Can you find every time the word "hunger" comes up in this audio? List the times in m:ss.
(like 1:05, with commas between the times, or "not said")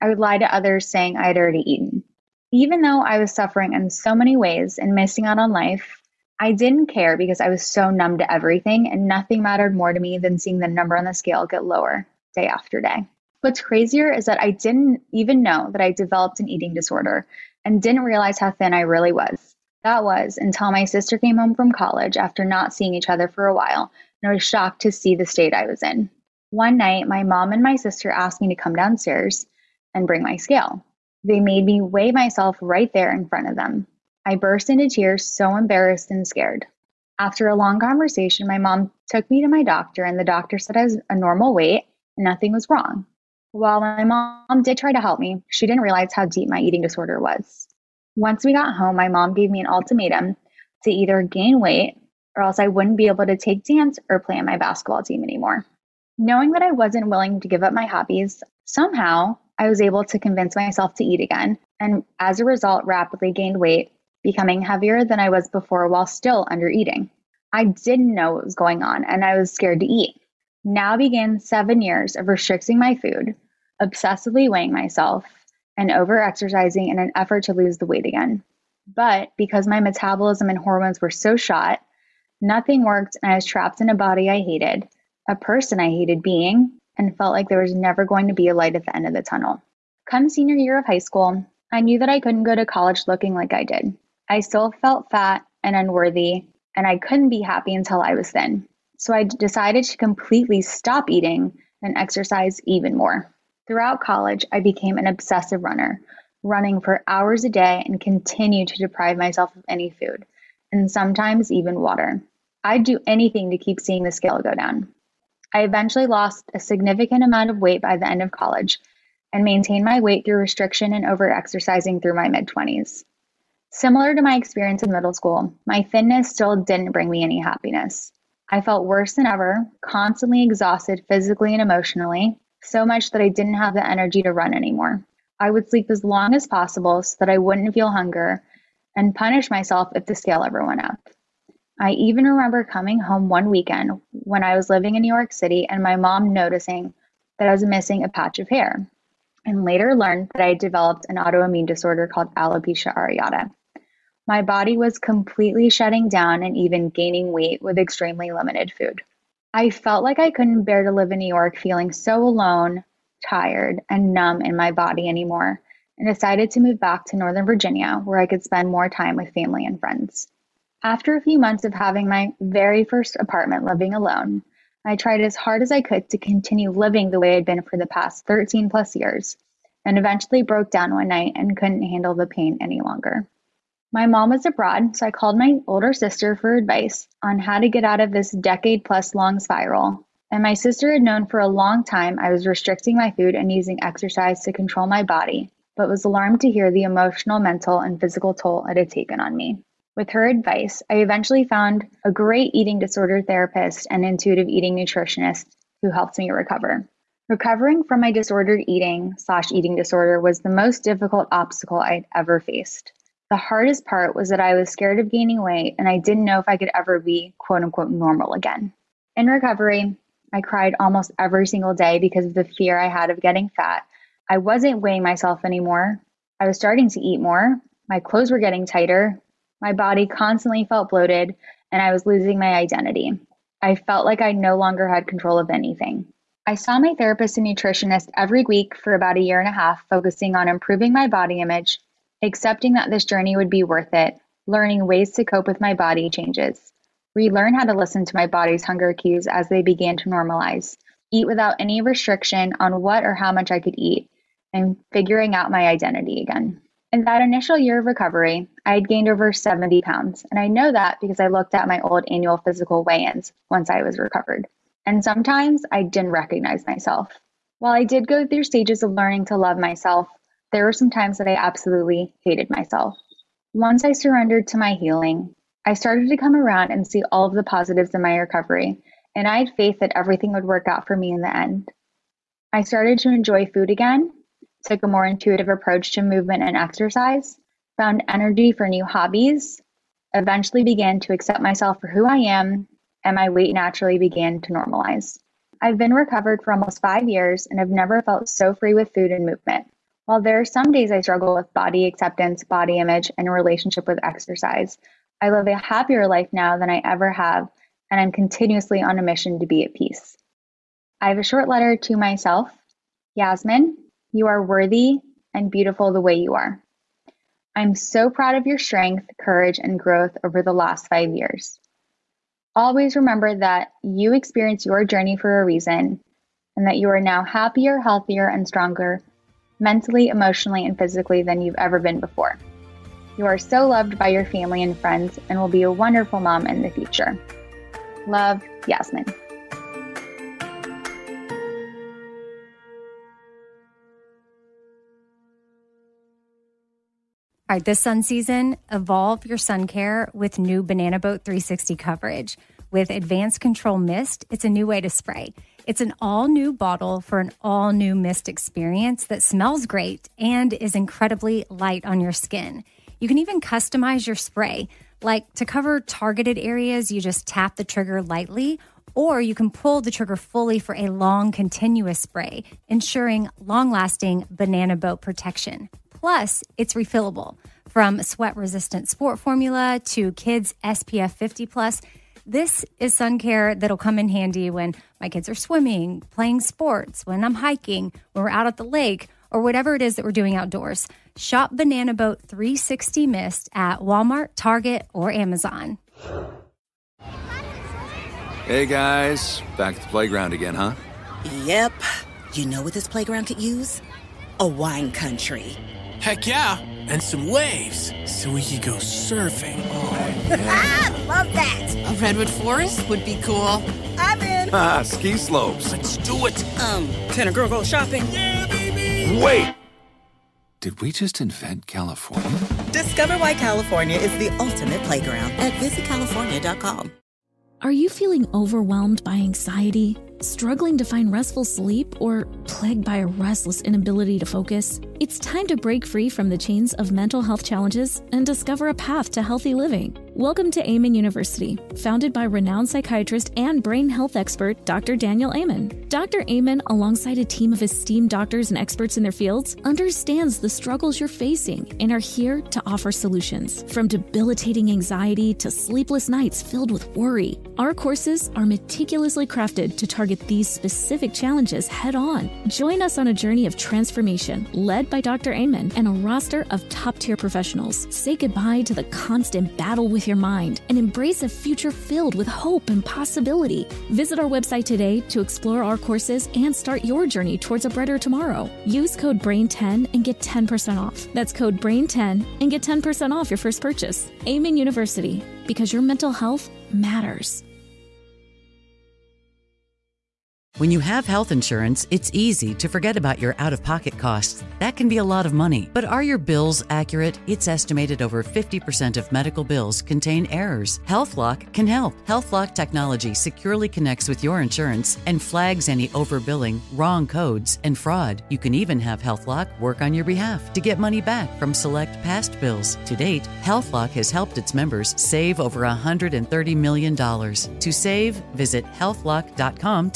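2:17, 4:08.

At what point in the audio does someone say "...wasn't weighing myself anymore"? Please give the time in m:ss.
3:44.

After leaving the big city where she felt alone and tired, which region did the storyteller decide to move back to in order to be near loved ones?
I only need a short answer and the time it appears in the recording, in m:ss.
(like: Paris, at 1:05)
Northern Virginia, at 2:47.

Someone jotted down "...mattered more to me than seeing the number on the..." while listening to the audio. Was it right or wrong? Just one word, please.
right.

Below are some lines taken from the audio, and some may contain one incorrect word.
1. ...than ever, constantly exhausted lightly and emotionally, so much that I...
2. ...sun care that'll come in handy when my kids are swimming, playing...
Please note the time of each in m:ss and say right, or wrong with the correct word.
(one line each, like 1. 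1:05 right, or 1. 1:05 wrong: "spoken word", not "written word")
1. 2:09 wrong: "physically", not "lightly"
2. 6:22 right.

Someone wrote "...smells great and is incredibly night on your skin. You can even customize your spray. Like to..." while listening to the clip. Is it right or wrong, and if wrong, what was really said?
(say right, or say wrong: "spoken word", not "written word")
wrong: "light", not "night".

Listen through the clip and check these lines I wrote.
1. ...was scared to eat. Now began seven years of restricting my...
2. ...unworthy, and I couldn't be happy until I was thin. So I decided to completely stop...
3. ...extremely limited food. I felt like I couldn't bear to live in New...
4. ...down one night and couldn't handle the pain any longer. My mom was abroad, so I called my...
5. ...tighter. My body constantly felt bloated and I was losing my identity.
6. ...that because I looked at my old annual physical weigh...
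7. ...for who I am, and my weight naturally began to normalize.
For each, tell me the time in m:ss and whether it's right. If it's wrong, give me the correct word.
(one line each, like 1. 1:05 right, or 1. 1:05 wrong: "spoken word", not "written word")
1. 1:09 right
2. 1:35 right
3. 2:37 right
4. 3:00 right
5. 3:48 right
6. 4:20 right
7. 4:51 right.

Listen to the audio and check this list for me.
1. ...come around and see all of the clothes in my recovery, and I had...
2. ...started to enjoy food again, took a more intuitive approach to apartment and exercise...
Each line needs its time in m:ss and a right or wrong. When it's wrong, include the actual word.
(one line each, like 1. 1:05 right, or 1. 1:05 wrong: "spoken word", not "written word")
1. 4:36 wrong: "positives", not "clothes"
2. 4:42 wrong: "movement", not "apartment".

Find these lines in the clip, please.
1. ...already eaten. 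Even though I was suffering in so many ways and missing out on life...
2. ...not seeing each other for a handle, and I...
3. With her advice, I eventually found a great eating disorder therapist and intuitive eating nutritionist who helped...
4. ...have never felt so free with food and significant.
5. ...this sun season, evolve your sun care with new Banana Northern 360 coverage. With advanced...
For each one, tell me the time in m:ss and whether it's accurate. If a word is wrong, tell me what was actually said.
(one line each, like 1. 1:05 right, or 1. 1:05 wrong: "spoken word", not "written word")
1. 0:01 right
2. 0:22 wrong: "while", not "handle"
3. 3:19 right
4. 4:57 wrong: "movement", not "significant"
5. 5:47 wrong: "Boat", not "Northern".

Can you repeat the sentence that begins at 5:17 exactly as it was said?
I'm so proud of your strength, courage, and growth over the last five years.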